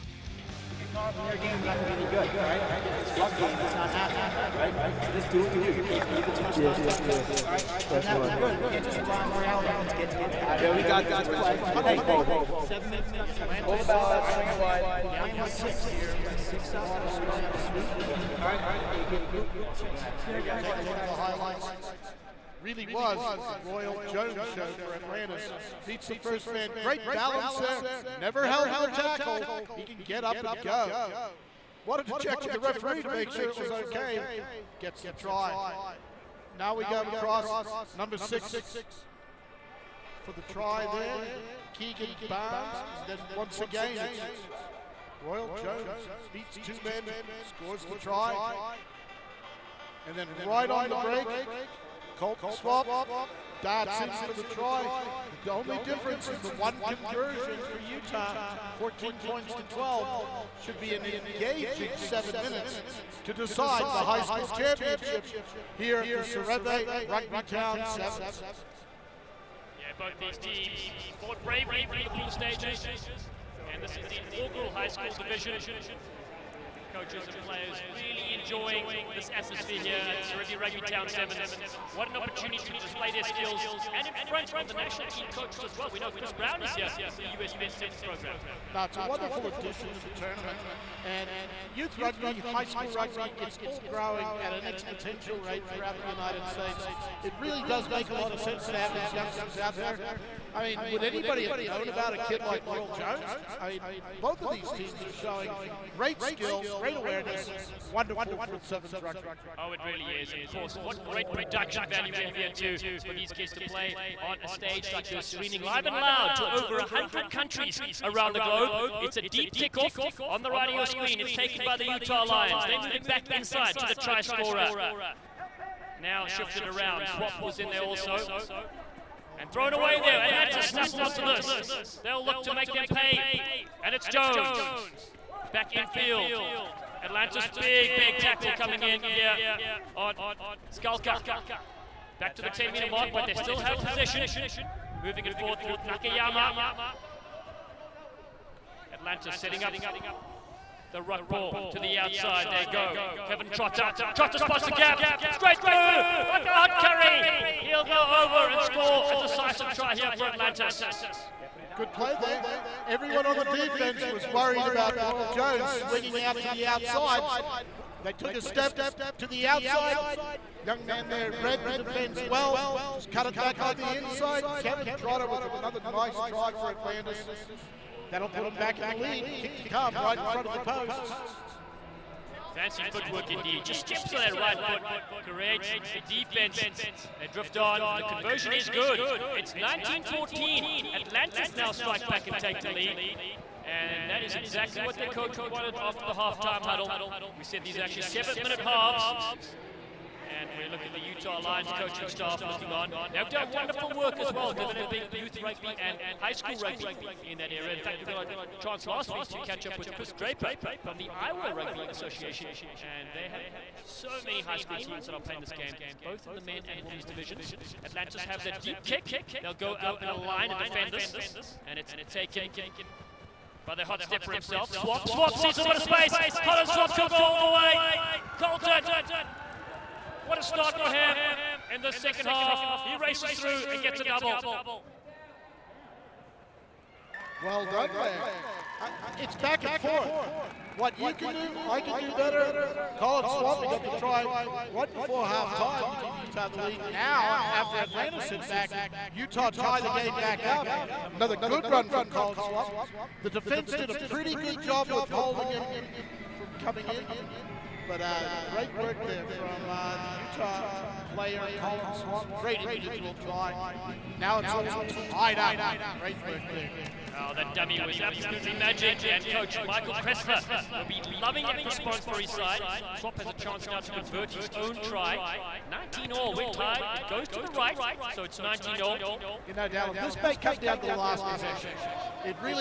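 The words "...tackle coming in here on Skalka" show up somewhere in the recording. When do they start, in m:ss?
2:18.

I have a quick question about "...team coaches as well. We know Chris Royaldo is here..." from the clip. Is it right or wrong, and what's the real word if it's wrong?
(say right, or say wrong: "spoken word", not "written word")
wrong: "Brown", not "Royaldo".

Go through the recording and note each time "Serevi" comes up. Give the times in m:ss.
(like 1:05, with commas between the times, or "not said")
1:06, 1:20.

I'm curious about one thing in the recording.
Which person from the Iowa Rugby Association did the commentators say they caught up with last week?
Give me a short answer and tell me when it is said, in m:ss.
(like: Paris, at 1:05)
Chris Draper, at 3:29.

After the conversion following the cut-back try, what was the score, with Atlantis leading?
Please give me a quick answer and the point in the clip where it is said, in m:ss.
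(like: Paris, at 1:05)
19-14, at 3:09.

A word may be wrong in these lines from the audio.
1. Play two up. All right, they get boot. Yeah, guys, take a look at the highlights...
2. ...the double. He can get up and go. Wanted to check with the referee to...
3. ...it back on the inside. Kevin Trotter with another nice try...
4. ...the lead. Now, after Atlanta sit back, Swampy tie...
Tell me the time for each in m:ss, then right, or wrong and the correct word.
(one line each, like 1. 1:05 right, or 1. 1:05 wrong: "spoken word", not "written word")
1. 0:16 wrong: "six", not "two"
2. 0:28 wrong: "tackle", not "double"
3. 2:53 right
4. 4:06 wrong: "Utah", not "Swampy".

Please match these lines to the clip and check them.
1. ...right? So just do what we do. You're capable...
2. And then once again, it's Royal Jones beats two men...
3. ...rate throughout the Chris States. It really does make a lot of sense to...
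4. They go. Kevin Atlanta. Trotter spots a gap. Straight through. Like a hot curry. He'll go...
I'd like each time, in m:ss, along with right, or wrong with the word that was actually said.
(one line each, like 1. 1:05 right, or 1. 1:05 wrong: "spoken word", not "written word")
1. 0:04 right
2. 0:42 right
3. 1:35 wrong: "United", not "Chris"
4. 2:32 wrong: "Trotter", not "Atlanta".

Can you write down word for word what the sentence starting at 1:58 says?
It's a deep kickoff on the right of your screen.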